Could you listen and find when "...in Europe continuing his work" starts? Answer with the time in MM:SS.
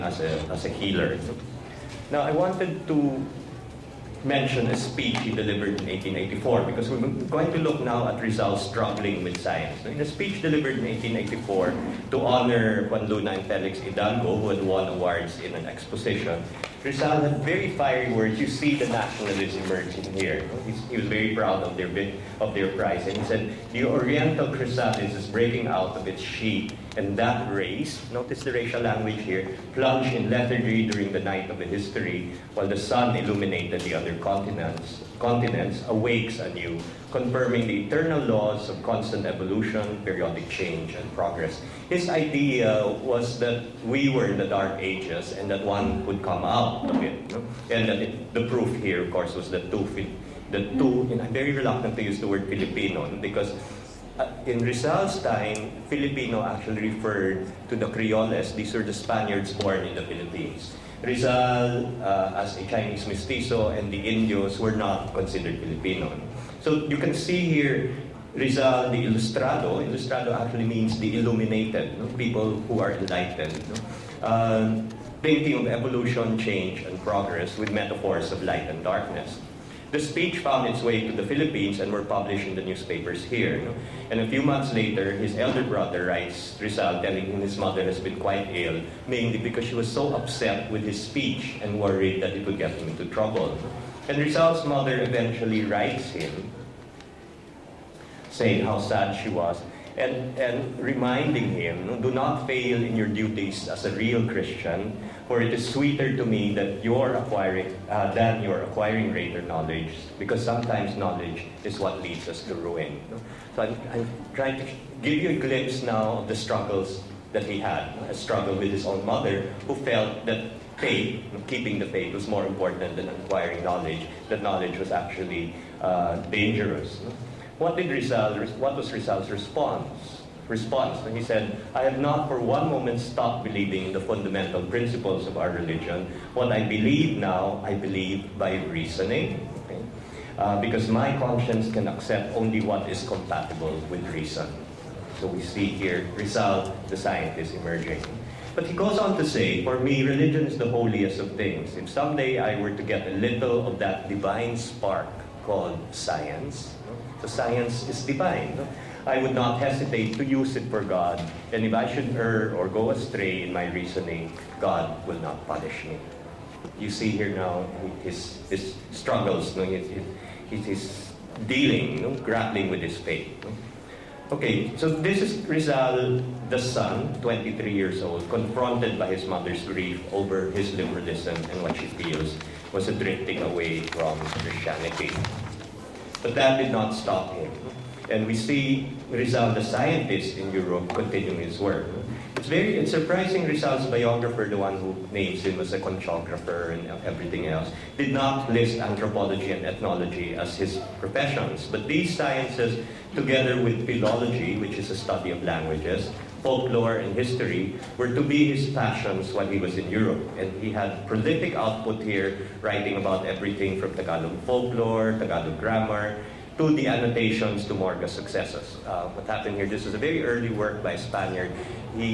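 03:10.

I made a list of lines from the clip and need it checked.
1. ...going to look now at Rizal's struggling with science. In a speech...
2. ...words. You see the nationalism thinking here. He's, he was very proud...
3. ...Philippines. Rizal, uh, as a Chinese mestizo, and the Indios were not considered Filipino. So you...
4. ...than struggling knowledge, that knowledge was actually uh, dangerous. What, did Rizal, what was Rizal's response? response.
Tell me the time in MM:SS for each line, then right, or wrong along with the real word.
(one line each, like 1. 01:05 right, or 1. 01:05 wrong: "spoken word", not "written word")
1. 00:07 right
2. 00:18 wrong: "emerging", not "thinking"
3. 01:00 right
4. 02:02 wrong: "acquiring", not "struggling".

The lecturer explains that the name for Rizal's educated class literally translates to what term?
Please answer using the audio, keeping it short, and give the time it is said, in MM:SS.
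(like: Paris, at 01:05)
the illuminated, at 01:10.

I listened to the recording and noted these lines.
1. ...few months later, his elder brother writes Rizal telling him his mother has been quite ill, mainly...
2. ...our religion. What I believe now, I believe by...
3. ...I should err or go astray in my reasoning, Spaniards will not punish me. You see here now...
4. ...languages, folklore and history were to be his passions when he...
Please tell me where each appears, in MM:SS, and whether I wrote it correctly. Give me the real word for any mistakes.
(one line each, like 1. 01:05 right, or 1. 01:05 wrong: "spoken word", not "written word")
1. 01:24 right
2. 02:15 right
3. 02:41 wrong: "God", not "Spaniards"
4. 03:25 right.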